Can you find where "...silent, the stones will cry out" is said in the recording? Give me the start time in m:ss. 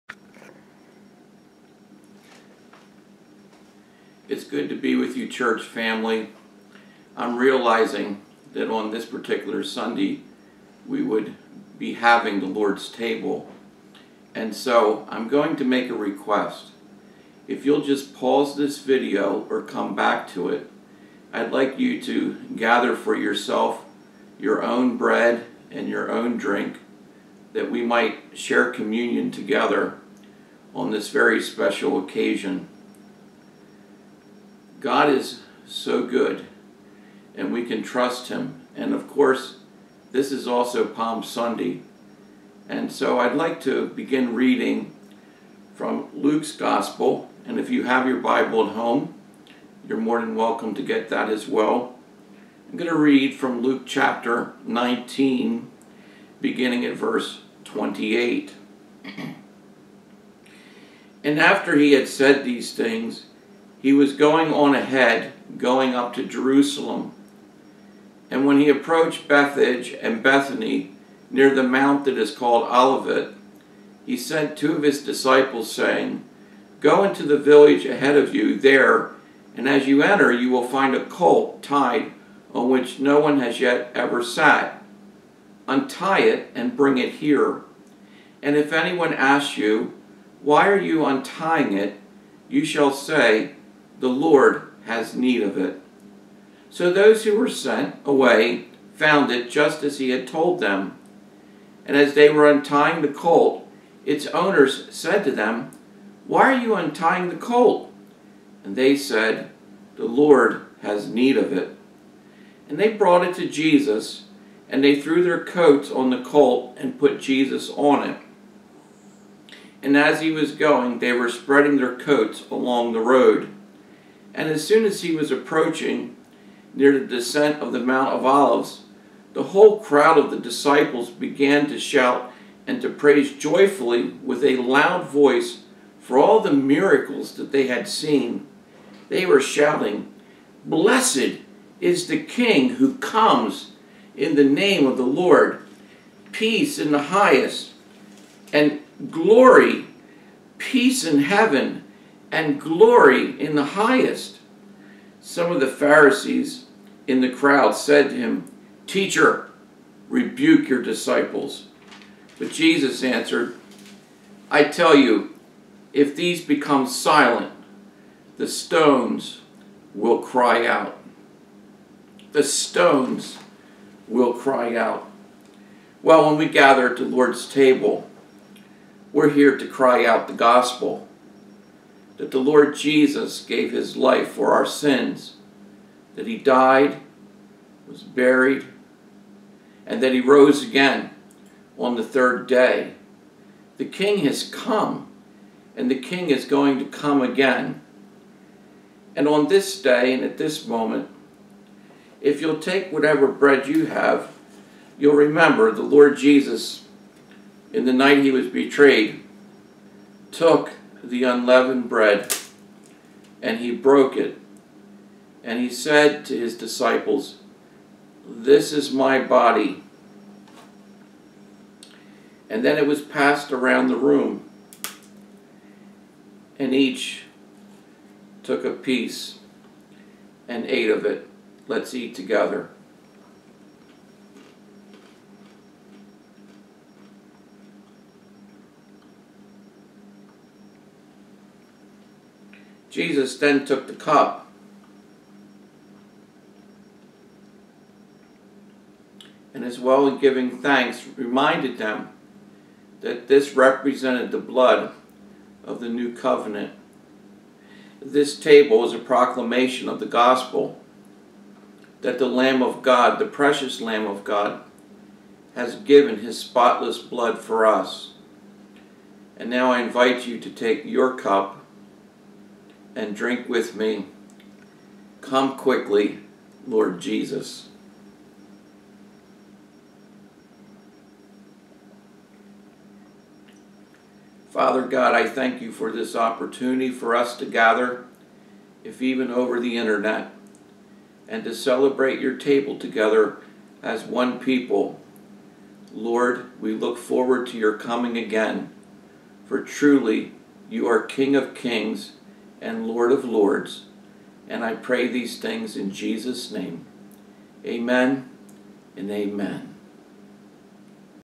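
2:46.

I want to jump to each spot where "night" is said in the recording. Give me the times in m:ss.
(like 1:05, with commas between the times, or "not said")
3:27.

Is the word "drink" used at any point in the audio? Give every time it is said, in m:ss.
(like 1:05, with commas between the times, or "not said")
0:26, 4:33.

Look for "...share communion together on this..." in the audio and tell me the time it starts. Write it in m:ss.
0:28.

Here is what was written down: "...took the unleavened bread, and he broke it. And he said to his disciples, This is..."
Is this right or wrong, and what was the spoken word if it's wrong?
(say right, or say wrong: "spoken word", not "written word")
right.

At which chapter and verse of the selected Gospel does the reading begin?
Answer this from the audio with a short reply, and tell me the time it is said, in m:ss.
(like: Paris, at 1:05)
Chapter 19, verse 28, at 0:53.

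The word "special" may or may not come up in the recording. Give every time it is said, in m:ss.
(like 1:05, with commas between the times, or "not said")
0:31.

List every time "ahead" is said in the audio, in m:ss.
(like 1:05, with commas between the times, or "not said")
1:04, 1:17.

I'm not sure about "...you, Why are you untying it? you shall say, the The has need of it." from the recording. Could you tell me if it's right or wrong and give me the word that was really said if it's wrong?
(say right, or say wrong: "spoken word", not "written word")
wrong: "Lord", not "The".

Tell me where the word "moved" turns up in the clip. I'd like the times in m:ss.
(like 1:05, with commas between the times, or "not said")
not said.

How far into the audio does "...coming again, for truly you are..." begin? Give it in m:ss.
4:57.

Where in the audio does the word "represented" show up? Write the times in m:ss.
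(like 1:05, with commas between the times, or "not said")
4:13.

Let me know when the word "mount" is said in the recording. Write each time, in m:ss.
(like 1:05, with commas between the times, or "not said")
1:11, 2:07.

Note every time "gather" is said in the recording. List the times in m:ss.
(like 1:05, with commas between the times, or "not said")
0:22, 2:56, 4:47.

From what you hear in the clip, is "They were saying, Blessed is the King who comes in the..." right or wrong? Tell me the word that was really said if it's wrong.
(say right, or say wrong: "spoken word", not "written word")
wrong: "shouting", not "saying".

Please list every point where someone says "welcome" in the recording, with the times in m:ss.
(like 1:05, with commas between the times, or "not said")
0:50.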